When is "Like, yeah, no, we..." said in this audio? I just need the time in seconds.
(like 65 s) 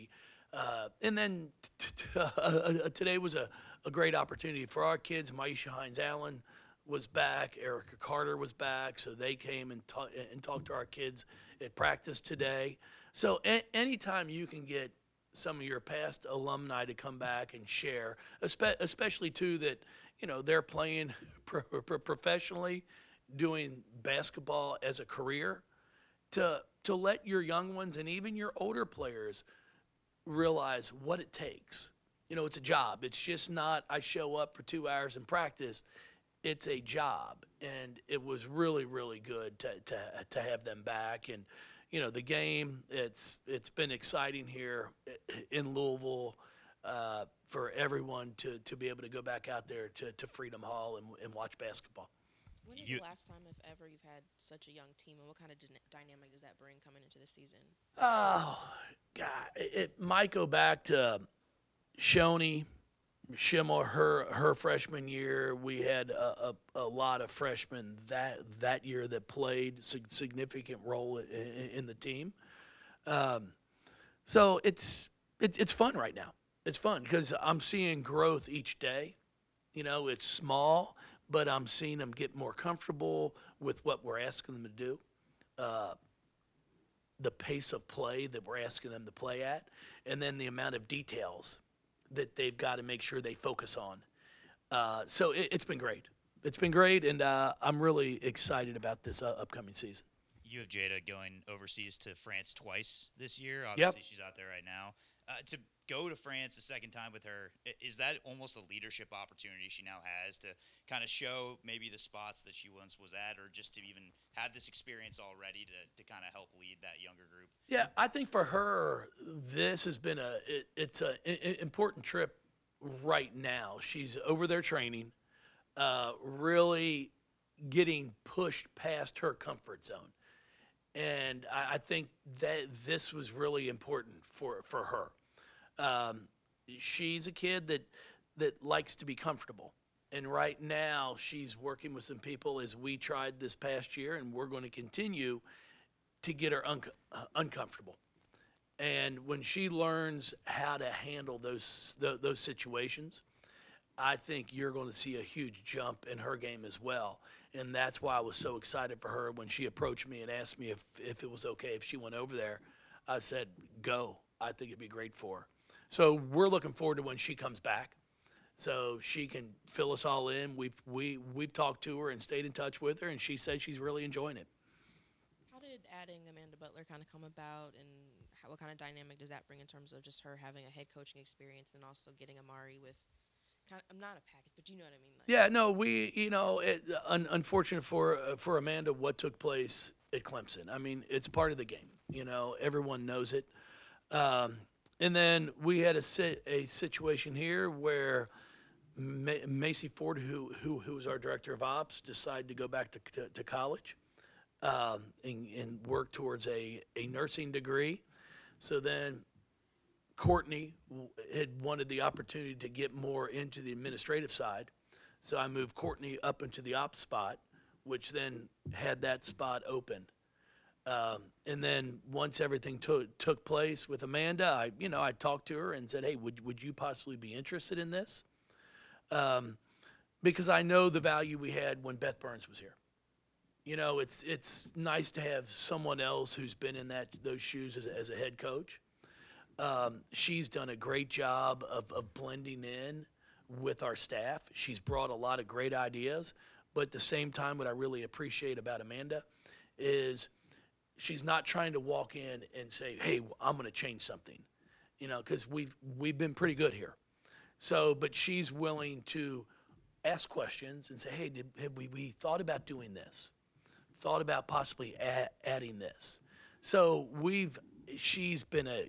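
185 s.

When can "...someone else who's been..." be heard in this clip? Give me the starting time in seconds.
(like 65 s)
235 s.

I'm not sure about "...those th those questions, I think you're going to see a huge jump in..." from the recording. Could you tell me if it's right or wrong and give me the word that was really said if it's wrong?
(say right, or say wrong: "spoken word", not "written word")
wrong: "situations", not "questions".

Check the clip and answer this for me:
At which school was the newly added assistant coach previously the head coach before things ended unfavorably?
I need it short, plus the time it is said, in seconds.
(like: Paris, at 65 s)
Clemson, at 190 s.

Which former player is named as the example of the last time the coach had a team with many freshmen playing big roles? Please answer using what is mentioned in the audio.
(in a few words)
Shoni Schimmel.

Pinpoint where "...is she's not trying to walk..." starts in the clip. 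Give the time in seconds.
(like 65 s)
249 s.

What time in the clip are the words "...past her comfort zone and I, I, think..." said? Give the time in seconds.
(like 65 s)
128 s.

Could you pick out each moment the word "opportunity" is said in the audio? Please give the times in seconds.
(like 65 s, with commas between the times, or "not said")
4 s, 109 s, 212 s.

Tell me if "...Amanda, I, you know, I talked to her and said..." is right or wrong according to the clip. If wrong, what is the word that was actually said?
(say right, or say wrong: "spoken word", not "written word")
right.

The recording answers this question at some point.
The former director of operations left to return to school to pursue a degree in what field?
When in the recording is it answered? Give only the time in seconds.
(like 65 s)
207 s.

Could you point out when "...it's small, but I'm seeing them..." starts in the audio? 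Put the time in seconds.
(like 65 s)
80 s.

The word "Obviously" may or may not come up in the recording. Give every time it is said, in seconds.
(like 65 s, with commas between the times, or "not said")
103 s.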